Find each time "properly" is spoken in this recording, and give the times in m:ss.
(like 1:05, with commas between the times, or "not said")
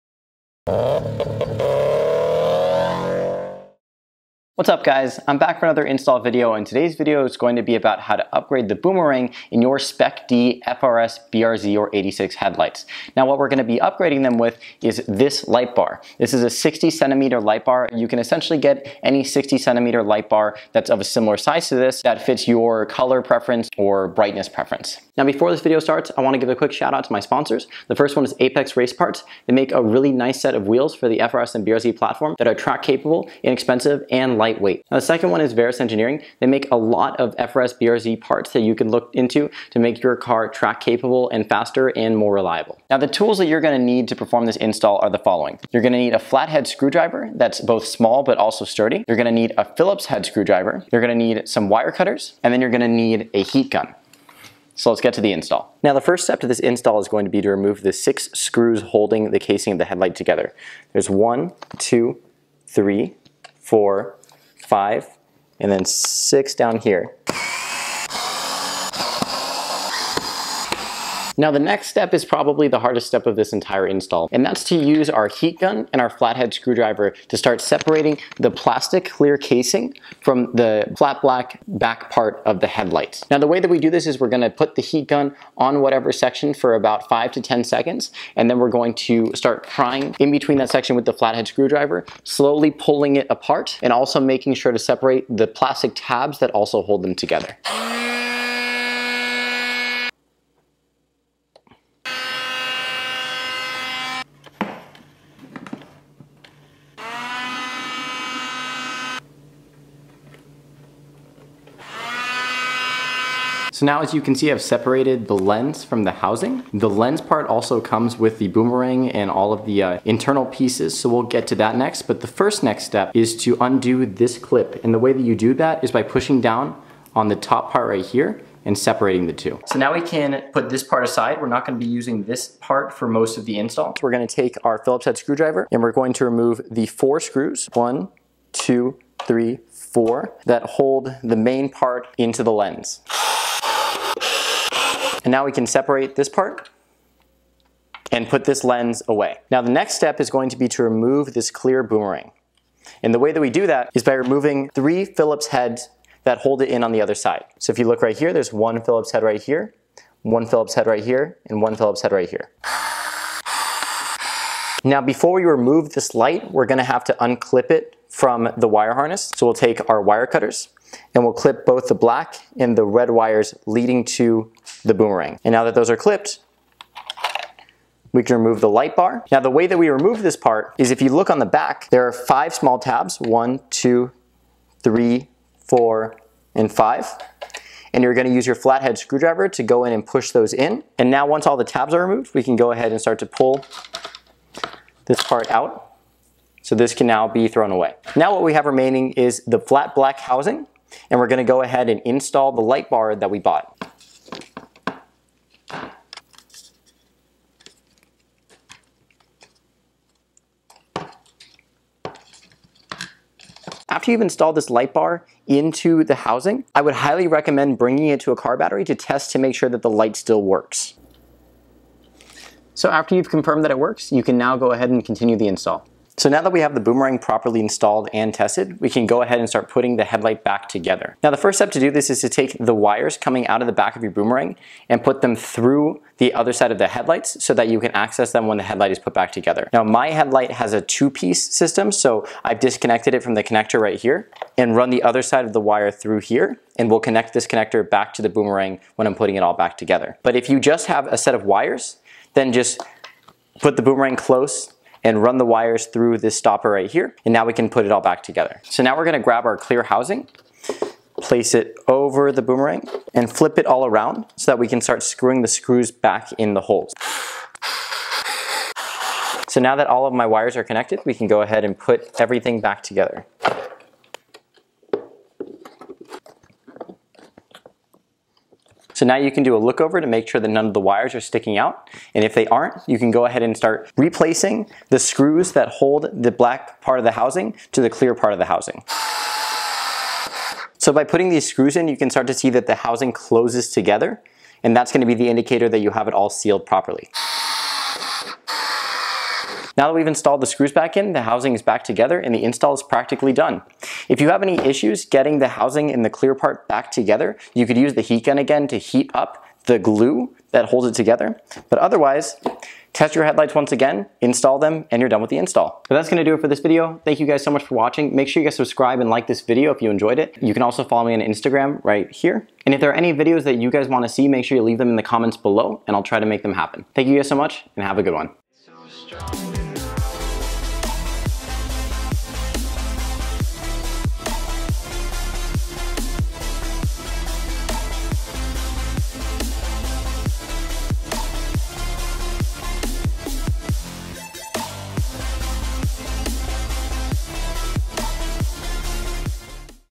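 3:47, 4:56.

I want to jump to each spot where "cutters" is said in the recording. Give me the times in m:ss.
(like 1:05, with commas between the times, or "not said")
0:51, 2:50.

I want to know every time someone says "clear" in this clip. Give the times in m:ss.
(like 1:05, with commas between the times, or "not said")
1:19, 2:31, 4:19, 4:47, 5:06.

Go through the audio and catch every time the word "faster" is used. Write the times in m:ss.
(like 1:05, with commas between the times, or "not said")
0:41.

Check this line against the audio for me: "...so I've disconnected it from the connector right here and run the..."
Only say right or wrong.
right.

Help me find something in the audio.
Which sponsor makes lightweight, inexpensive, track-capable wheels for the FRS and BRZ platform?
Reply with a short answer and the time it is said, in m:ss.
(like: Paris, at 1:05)
Apex Race Parts, at 0:28.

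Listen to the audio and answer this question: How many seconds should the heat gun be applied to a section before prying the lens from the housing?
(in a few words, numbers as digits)
5 to 10.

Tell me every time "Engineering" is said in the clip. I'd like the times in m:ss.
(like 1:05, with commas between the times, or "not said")
0:35.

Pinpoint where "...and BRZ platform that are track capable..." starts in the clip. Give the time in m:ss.
0:31.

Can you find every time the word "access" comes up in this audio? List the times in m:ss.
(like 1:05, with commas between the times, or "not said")
3:57.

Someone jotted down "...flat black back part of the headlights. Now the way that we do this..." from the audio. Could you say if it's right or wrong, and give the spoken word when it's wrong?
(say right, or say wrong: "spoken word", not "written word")
right.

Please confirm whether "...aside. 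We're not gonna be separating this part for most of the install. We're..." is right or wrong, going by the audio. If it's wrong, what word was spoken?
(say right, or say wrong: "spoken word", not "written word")
wrong: "using", not "separating".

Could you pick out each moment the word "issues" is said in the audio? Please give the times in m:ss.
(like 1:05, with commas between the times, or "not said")
5:04.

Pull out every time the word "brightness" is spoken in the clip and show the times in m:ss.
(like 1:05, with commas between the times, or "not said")
0:24.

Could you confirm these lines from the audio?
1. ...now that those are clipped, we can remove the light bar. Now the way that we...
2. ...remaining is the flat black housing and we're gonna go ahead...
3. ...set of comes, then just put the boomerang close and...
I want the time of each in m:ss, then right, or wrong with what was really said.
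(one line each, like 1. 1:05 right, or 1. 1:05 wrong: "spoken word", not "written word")
1. 2:55 right
2. 3:18 right
3. 4:11 wrong: "wires", not "comes".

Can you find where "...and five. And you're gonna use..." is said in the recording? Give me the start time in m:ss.
3:06.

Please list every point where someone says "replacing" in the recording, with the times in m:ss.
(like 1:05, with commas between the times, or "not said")
4:43.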